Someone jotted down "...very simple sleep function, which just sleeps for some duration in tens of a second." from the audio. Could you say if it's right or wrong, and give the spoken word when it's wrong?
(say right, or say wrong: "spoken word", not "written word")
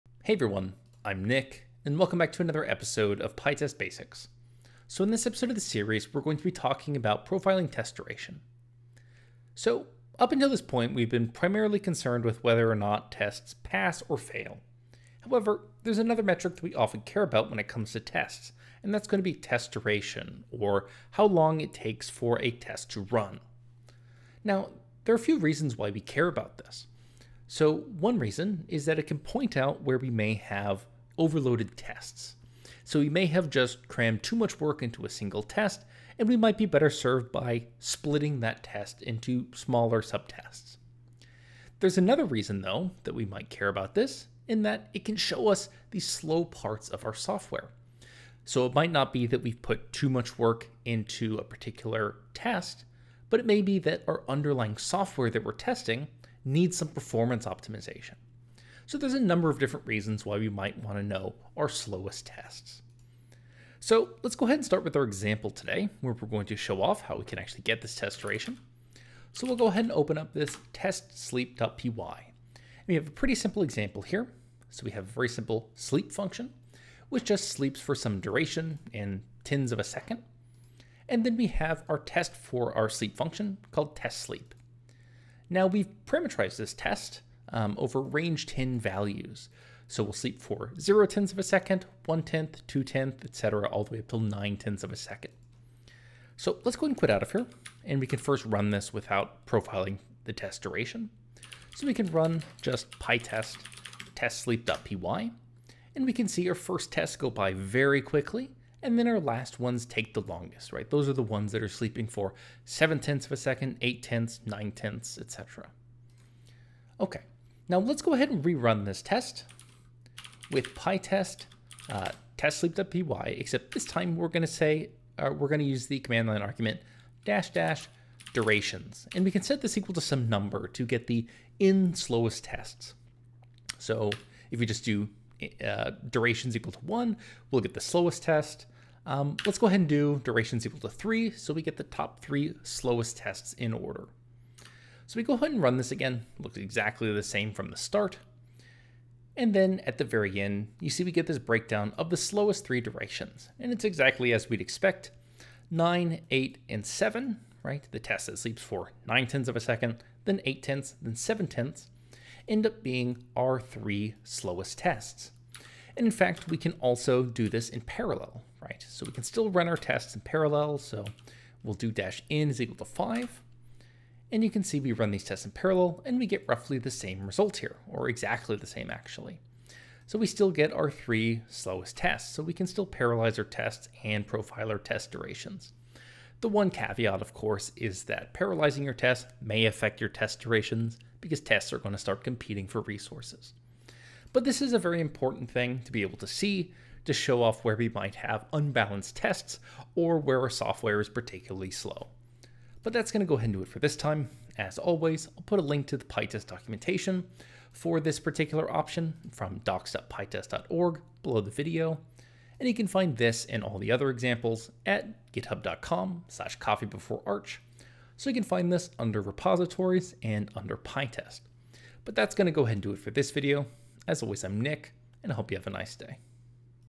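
right.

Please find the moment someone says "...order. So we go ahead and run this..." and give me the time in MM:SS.
02:23.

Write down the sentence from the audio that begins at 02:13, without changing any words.
So if you just do uh, durations equal to one, we'll get the slowest test.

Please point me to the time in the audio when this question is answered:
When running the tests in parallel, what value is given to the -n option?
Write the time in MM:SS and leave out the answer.
02:51.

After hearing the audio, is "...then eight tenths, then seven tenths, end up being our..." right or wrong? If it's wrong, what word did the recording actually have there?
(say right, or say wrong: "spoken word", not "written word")
right.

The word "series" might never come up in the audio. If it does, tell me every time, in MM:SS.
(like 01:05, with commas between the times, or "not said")
00:05.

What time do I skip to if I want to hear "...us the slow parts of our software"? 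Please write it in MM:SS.
00:45.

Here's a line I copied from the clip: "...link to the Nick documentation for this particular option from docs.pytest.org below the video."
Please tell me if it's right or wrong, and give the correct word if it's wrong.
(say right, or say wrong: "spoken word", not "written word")
wrong: "PyTest", not "Nick".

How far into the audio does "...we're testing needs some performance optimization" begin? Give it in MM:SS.
00:55.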